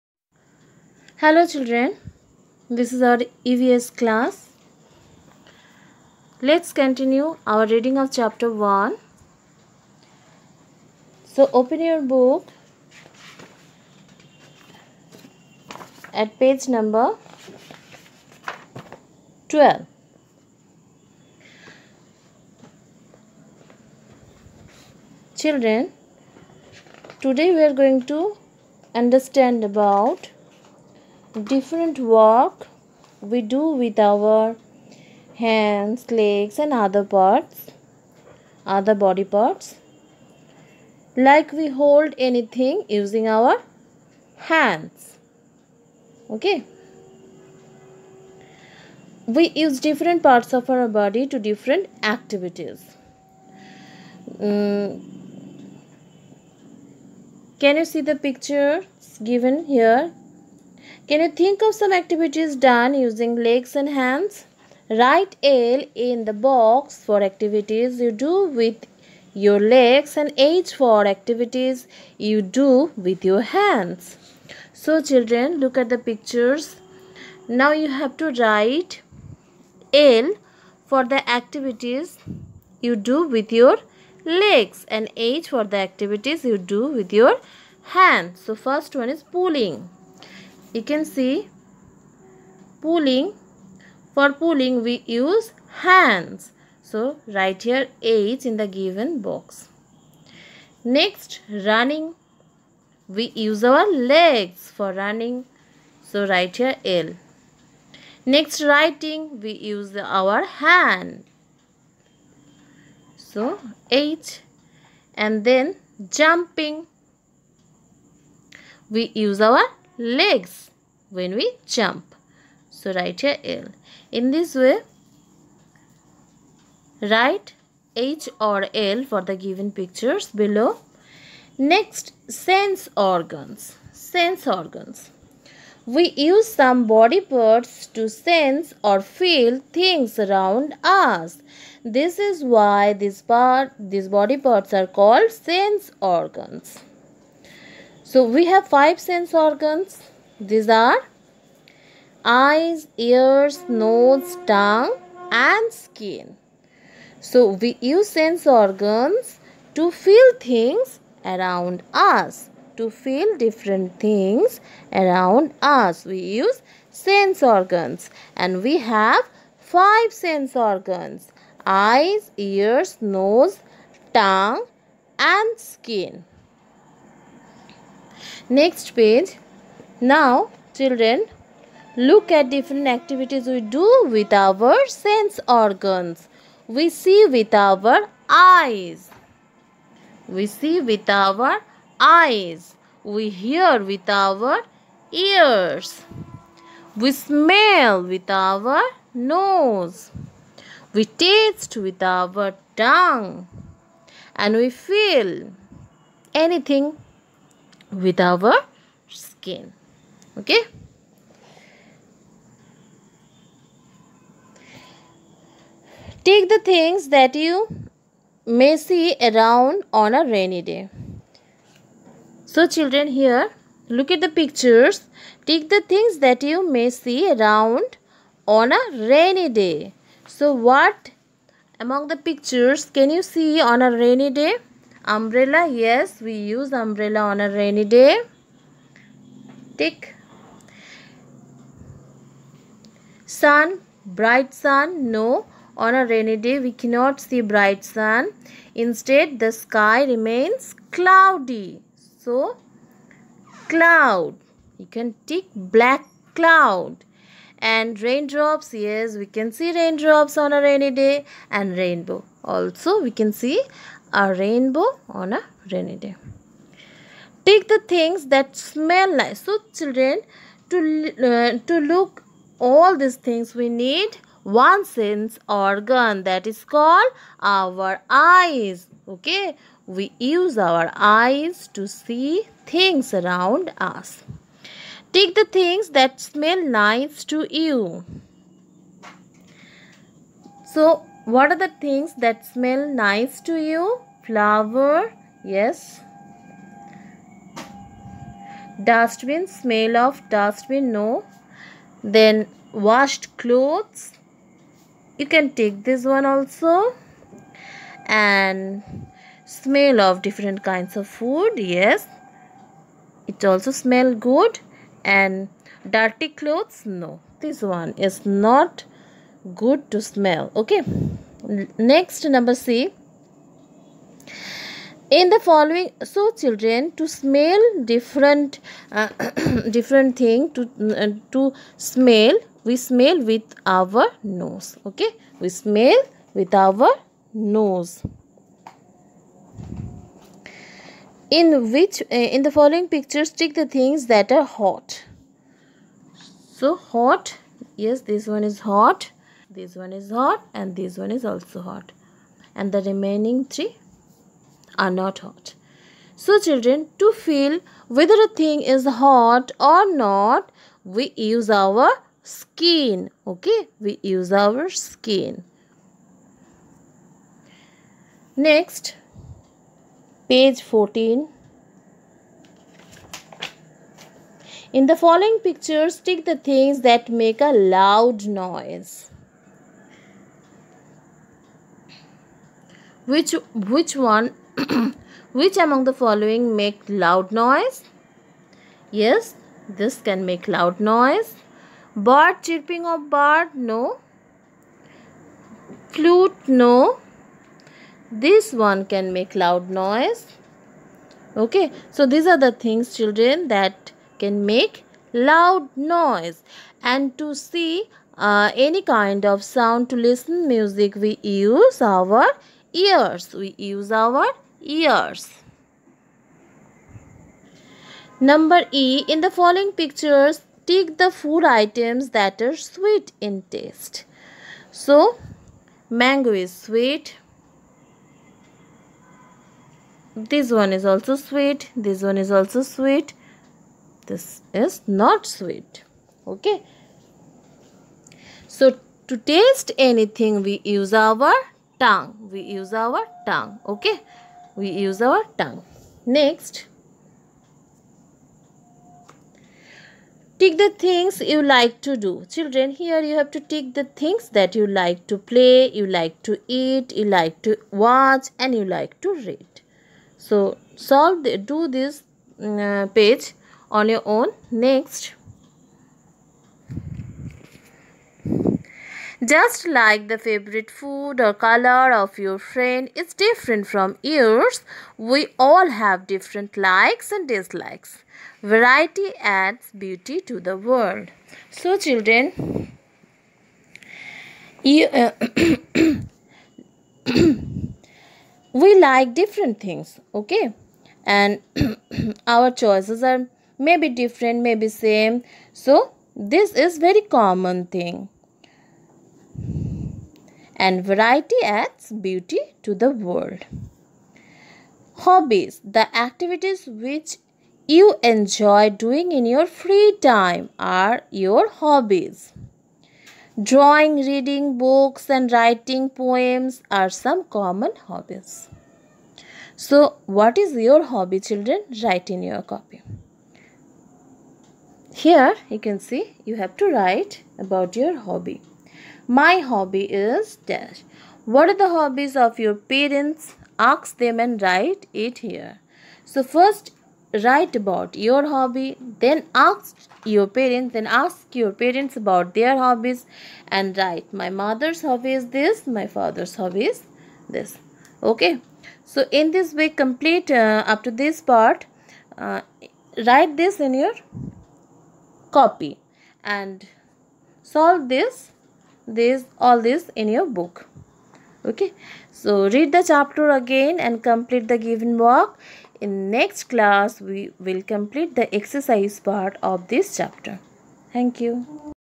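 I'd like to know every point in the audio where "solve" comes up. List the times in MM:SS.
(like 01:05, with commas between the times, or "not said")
07:40, 09:17.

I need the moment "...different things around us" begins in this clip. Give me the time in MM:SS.
02:43.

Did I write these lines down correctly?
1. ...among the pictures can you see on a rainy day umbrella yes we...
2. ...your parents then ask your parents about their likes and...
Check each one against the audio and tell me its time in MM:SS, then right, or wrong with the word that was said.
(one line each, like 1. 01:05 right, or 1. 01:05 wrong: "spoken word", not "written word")
1. 03:51 right
2. 09:00 wrong: "hobbies", not "likes".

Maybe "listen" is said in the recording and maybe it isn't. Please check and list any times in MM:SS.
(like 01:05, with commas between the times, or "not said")
06:49.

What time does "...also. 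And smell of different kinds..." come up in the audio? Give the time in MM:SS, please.
05:06.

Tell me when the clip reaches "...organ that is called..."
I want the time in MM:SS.
04:35.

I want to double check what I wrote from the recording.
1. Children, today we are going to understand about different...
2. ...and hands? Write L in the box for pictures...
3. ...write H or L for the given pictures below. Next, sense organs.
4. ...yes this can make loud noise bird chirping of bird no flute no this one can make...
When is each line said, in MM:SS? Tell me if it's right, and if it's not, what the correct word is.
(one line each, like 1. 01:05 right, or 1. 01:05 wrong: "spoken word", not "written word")
1. 00:25 right
2. 01:03 wrong: "activities", not "pictures"
3. 02:07 right
4. 06:28 right.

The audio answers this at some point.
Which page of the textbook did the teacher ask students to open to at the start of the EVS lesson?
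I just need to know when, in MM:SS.
00:19.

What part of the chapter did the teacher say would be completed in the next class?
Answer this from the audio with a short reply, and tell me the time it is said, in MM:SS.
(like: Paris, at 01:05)
Exercise part, at 09:28.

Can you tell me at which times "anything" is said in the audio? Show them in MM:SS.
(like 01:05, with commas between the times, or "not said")
00:42, 03:26, 07:19.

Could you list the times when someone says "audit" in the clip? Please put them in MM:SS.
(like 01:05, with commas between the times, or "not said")
not said.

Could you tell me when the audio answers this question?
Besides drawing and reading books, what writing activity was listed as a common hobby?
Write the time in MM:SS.
08:35.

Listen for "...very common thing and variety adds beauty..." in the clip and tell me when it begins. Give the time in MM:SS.
08:16.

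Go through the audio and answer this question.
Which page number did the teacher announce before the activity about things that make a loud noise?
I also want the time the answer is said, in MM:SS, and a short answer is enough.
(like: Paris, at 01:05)
14, at 06:10.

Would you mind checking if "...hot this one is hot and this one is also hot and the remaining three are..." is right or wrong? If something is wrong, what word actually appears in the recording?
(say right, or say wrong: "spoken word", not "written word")
right.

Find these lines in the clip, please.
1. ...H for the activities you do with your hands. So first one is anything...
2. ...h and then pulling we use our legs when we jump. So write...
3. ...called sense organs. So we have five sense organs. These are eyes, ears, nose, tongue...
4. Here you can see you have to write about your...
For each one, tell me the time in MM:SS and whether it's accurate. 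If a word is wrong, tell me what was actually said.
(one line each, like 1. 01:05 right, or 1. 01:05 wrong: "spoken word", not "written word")
1. 01:25 wrong: "pulling", not "anything"
2. 01:53 wrong: "jumping", not "pulling"
3. 02:24 right
4. 08:45 right.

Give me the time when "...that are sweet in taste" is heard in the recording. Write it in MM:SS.
07:02.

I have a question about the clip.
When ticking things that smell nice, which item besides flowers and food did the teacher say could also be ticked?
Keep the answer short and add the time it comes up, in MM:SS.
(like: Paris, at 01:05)
Washed clothes, at 05:02.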